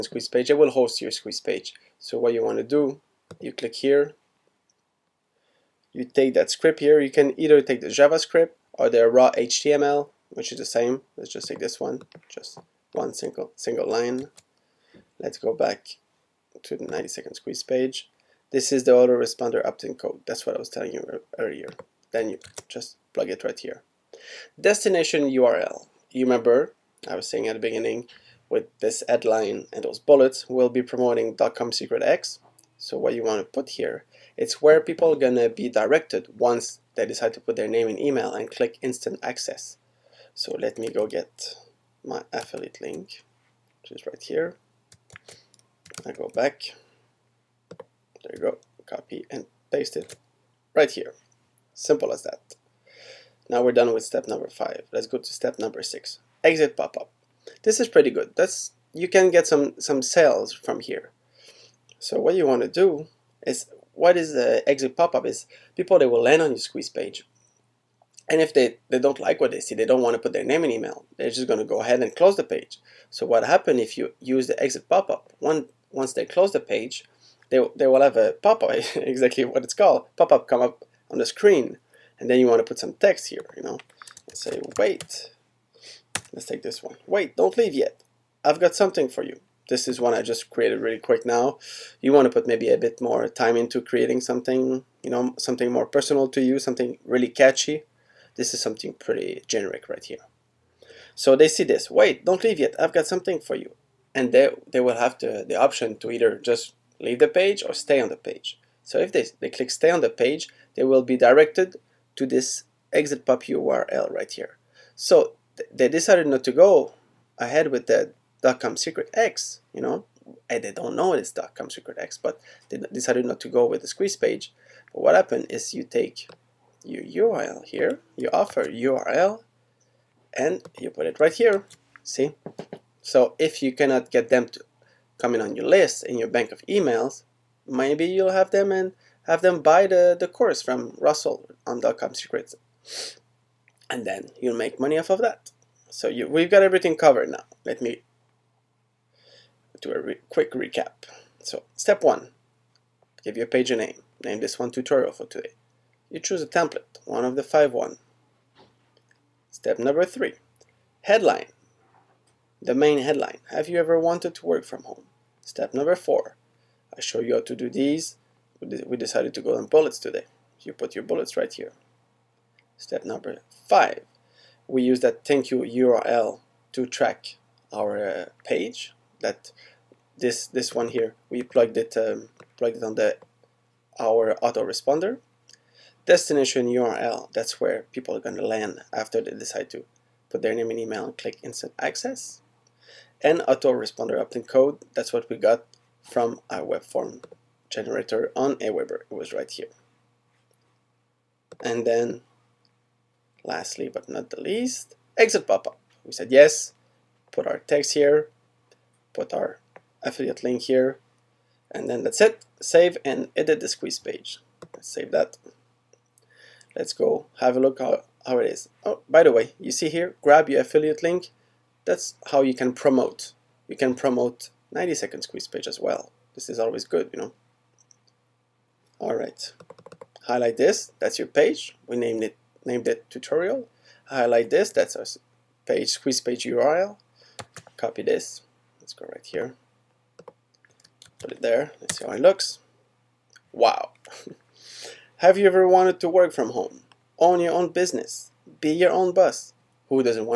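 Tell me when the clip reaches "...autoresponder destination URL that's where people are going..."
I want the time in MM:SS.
03:04.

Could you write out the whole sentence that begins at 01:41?
So they see this, wait, don't leave yet, I've got something for you.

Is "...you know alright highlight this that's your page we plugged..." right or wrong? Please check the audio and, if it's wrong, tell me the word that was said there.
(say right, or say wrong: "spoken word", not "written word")
wrong: "named", not "plugged".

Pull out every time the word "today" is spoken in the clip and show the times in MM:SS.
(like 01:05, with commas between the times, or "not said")
02:35, 02:49.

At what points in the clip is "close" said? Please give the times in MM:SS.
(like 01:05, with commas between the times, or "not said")
01:12, 01:16.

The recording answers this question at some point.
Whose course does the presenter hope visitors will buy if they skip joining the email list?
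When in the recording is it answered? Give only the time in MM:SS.
02:21.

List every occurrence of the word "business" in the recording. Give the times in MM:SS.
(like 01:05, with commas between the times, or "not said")
04:07.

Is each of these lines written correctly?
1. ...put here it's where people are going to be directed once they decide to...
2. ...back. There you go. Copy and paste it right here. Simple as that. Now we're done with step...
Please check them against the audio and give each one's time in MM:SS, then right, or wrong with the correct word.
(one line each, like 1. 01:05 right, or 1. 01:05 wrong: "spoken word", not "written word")
1. 00:33 right
2. 00:46 right.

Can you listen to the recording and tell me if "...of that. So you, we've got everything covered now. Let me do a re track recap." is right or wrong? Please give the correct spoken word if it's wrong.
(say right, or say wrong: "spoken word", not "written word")
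wrong: "quick", not "track".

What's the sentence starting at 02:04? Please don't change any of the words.
But what happened is you take your URL here, your offer URL, and you put it right here.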